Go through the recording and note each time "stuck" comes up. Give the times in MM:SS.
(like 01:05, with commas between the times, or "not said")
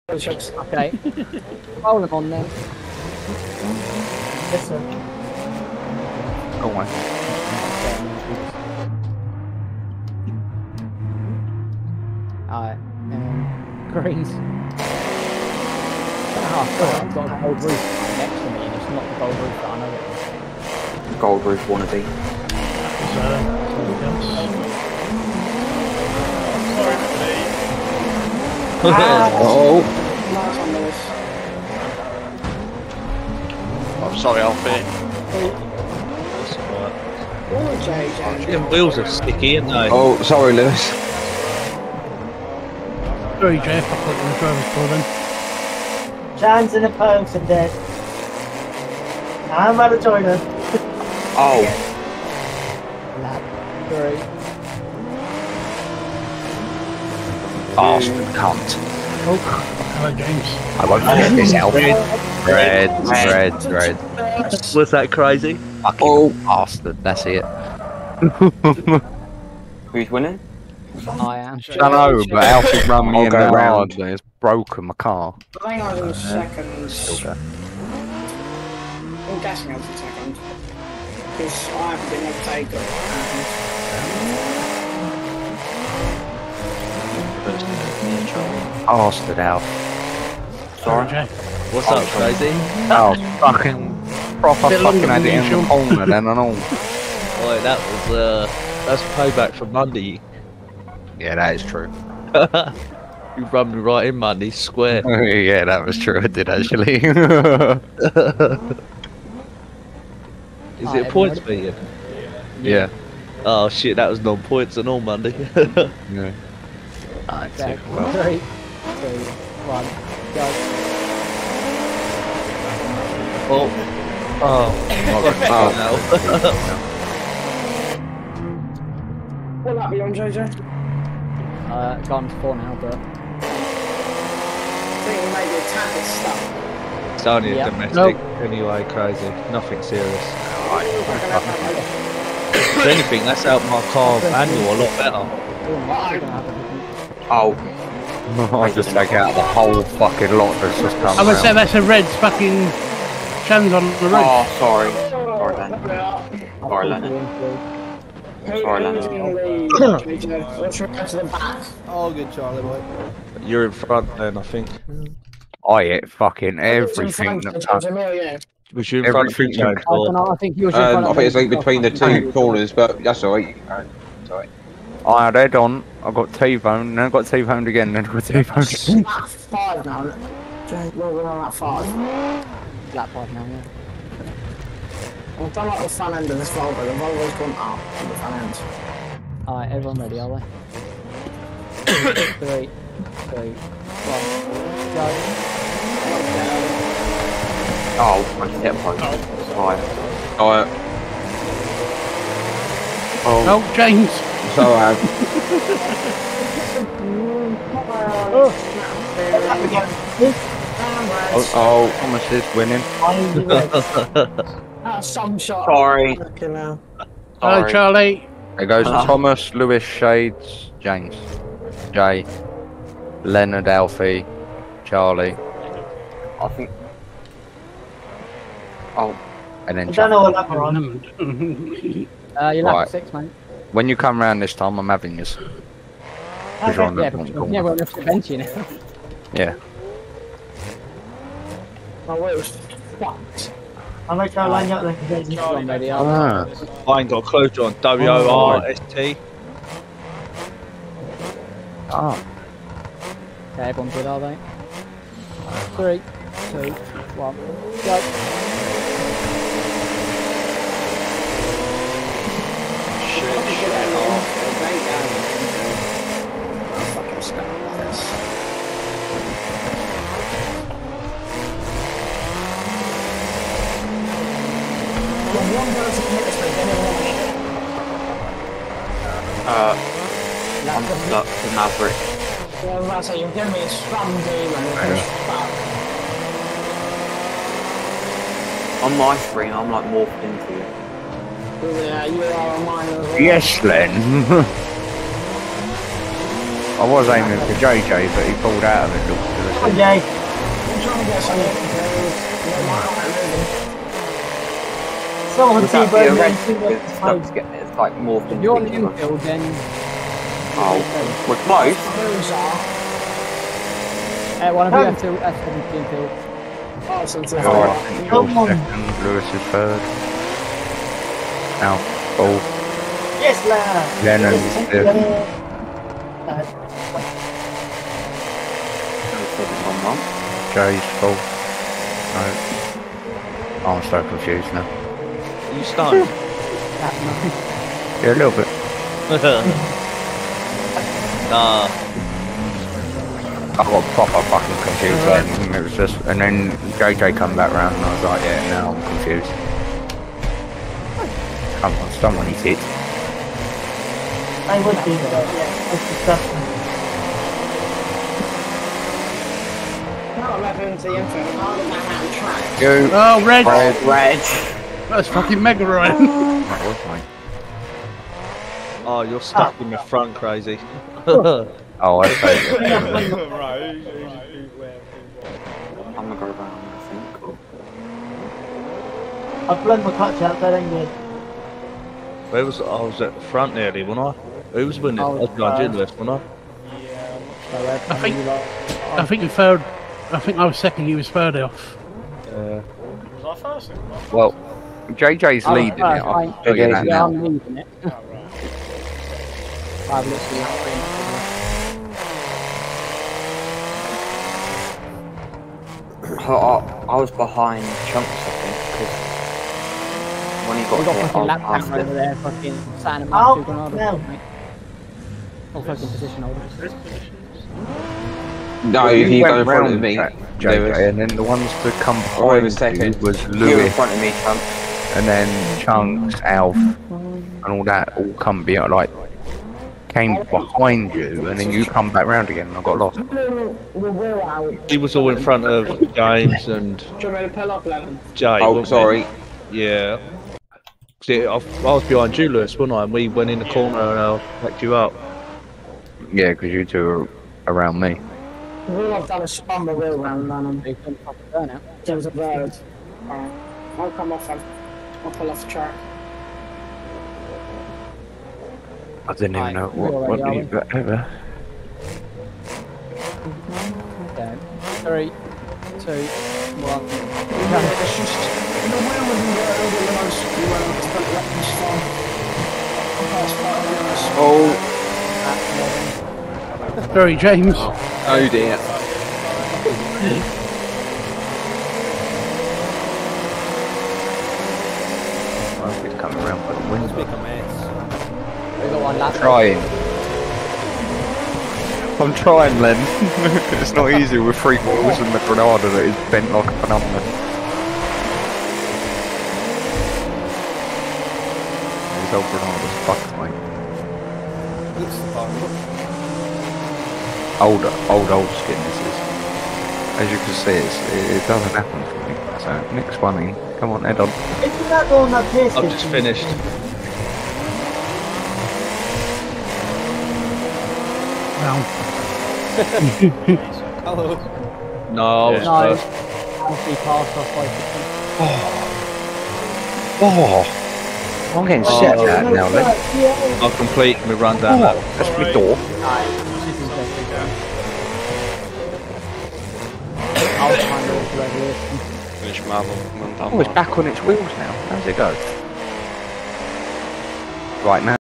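02:16, 04:40, 06:09.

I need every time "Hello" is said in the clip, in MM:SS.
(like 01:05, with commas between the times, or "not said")
03:36, 08:42.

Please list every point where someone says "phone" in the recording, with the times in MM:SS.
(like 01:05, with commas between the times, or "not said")
00:46.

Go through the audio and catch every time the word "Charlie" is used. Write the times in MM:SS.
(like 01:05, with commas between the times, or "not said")
02:42, 03:37, 03:44, 03:49.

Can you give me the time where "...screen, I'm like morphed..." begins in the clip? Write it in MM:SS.
04:49.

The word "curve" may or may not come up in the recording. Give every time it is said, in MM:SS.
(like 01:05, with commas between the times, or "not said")
not said.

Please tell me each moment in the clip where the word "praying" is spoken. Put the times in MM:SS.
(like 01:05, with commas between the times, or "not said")
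not said.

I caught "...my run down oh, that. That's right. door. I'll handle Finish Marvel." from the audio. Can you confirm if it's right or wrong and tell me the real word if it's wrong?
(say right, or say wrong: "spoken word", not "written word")
right.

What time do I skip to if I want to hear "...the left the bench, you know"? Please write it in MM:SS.
03:56.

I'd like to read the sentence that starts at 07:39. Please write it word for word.
I didn't even know what, what, what ever.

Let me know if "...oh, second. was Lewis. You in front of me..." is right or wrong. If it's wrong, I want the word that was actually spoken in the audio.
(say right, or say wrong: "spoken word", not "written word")
right.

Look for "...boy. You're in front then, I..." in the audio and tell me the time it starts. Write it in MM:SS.
02:42.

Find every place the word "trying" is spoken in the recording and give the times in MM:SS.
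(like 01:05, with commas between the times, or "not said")
05:00, 08:12.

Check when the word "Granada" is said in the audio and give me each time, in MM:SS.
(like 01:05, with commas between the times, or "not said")
08:15, 08:22.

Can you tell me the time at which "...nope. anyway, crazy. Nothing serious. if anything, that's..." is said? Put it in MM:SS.
02:17.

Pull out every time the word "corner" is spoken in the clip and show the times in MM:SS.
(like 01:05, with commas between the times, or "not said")
01:35, 02:52, 07:23.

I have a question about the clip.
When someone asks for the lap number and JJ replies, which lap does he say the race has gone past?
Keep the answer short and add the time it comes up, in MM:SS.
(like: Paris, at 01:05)
4, at 02:12.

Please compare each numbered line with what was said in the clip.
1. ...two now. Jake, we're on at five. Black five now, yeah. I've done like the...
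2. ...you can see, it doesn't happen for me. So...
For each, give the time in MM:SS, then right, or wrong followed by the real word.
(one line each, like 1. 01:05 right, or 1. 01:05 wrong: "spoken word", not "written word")
1. 02:58 wrong: "five", not "two"
2. 08:30 right.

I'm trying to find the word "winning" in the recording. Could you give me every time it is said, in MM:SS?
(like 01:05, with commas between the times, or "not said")
01:10, 03:32, 06:24.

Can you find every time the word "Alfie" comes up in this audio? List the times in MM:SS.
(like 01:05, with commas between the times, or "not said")
00:34, 03:43.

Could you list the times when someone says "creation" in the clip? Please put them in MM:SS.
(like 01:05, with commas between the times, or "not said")
not said.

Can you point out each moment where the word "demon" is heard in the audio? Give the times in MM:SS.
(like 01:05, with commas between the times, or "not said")
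04:44.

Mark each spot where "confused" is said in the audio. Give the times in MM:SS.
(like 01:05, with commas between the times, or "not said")
05:34, 05:44, 05:48.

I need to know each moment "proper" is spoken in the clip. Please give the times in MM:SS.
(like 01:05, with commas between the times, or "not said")
01:34, 05:43.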